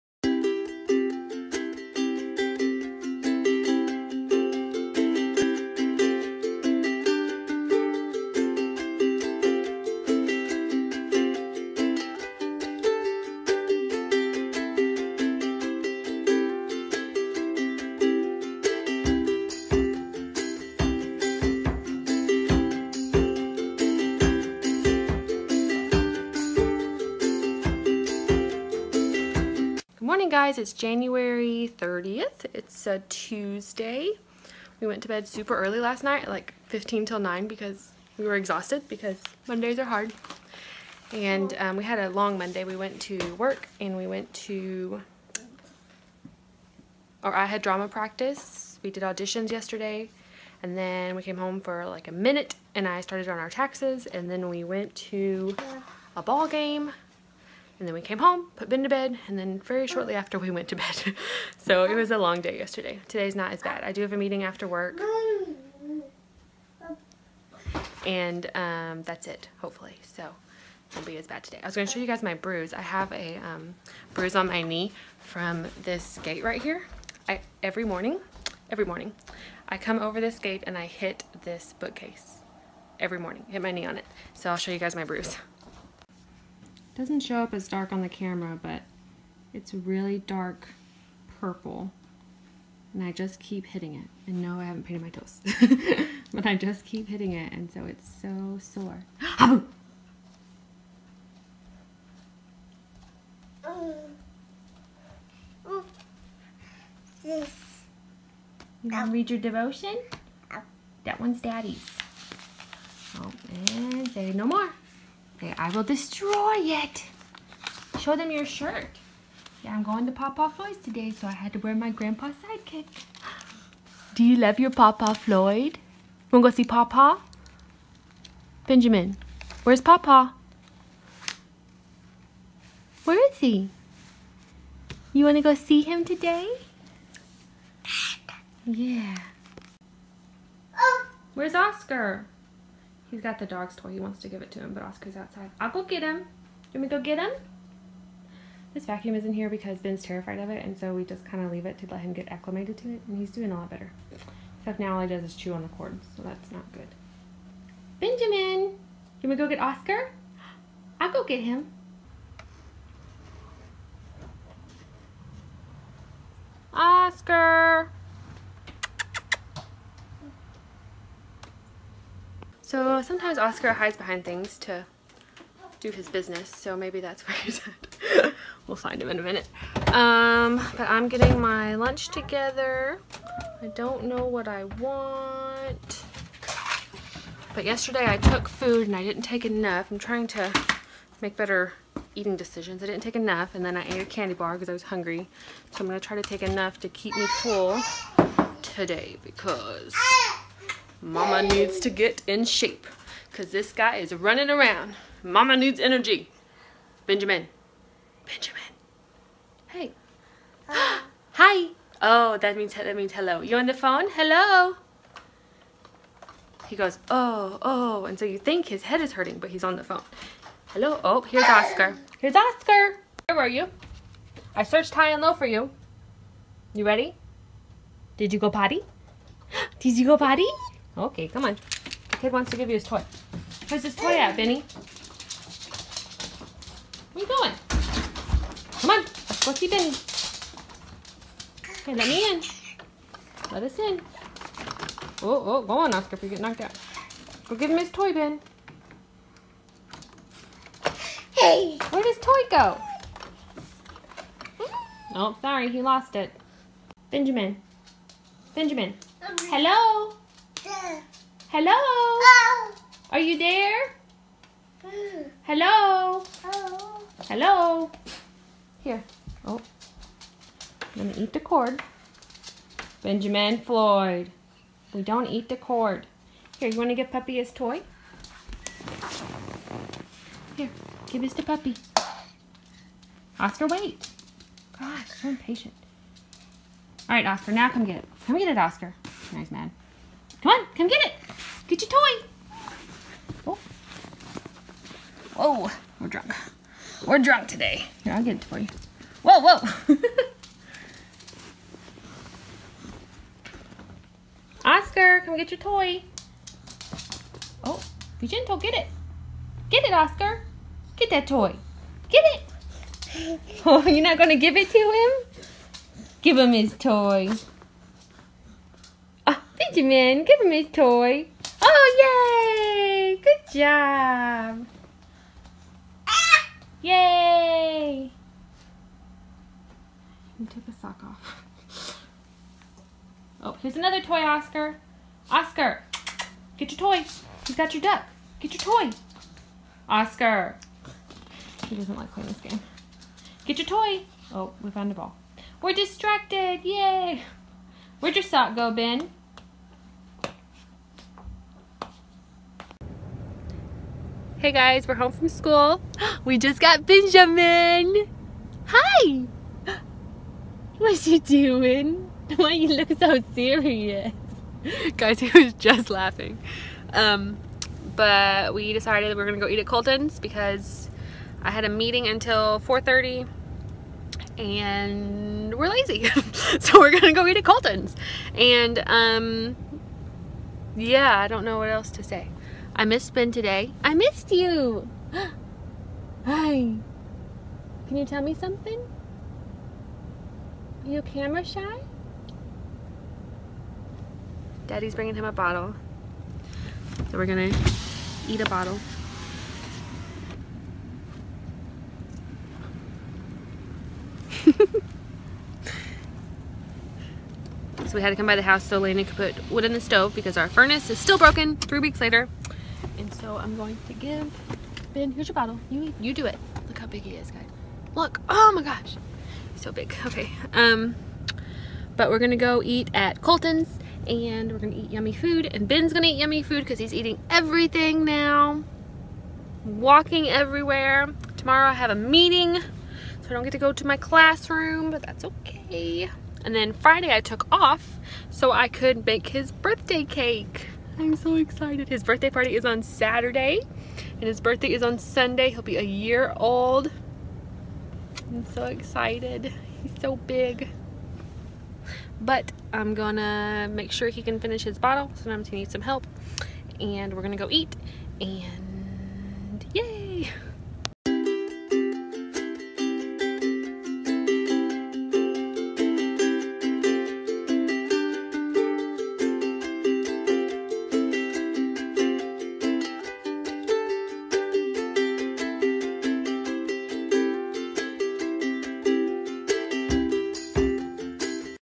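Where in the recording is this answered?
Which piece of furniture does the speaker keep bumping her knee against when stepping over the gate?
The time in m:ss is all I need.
1:21.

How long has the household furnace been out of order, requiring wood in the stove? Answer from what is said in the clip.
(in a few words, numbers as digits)
3 weeks.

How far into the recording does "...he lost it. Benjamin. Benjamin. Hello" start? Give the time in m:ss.
4:15.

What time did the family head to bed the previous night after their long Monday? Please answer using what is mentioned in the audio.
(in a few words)
8:45.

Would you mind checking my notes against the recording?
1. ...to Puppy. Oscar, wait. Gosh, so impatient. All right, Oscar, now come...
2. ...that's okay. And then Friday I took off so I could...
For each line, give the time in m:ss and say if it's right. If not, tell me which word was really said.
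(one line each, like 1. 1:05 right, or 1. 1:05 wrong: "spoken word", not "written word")
1. 4:41 right
2. 7:15 right.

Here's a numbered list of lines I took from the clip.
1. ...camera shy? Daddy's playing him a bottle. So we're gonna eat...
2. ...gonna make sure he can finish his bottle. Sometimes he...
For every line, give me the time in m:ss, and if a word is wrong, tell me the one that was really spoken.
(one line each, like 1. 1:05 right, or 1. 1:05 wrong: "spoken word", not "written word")
1. 6:31 wrong: "bringing", not "playing"
2. 7:32 right.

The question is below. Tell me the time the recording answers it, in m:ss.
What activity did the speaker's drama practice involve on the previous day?
0:49.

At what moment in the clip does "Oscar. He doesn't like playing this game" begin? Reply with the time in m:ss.
5:39.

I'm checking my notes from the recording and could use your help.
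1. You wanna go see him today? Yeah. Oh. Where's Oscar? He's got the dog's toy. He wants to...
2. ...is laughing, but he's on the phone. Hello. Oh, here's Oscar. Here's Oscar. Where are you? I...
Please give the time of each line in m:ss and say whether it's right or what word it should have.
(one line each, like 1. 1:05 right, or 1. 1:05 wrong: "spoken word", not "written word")
1. 2:15 right
2. 3:39 wrong: "hurting", not "laughing".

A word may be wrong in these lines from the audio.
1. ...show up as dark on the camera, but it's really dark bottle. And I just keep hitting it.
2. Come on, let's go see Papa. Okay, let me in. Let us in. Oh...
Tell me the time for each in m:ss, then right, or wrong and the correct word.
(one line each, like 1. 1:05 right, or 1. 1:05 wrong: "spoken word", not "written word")
1. 1:27 wrong: "purple", not "bottle"
2. 3:58 wrong: "Benny", not "Papa".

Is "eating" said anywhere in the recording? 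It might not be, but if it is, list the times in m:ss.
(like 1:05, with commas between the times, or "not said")
3:12, 7:06.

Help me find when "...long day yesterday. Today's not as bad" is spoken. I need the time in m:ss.
1:02.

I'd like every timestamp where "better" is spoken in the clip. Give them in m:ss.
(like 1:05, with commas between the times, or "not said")
2:33, 3:11.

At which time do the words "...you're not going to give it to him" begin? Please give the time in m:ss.
5:13.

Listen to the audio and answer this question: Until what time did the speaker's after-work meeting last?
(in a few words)
4:30.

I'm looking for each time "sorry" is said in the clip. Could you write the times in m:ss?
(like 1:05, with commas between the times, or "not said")
4:15.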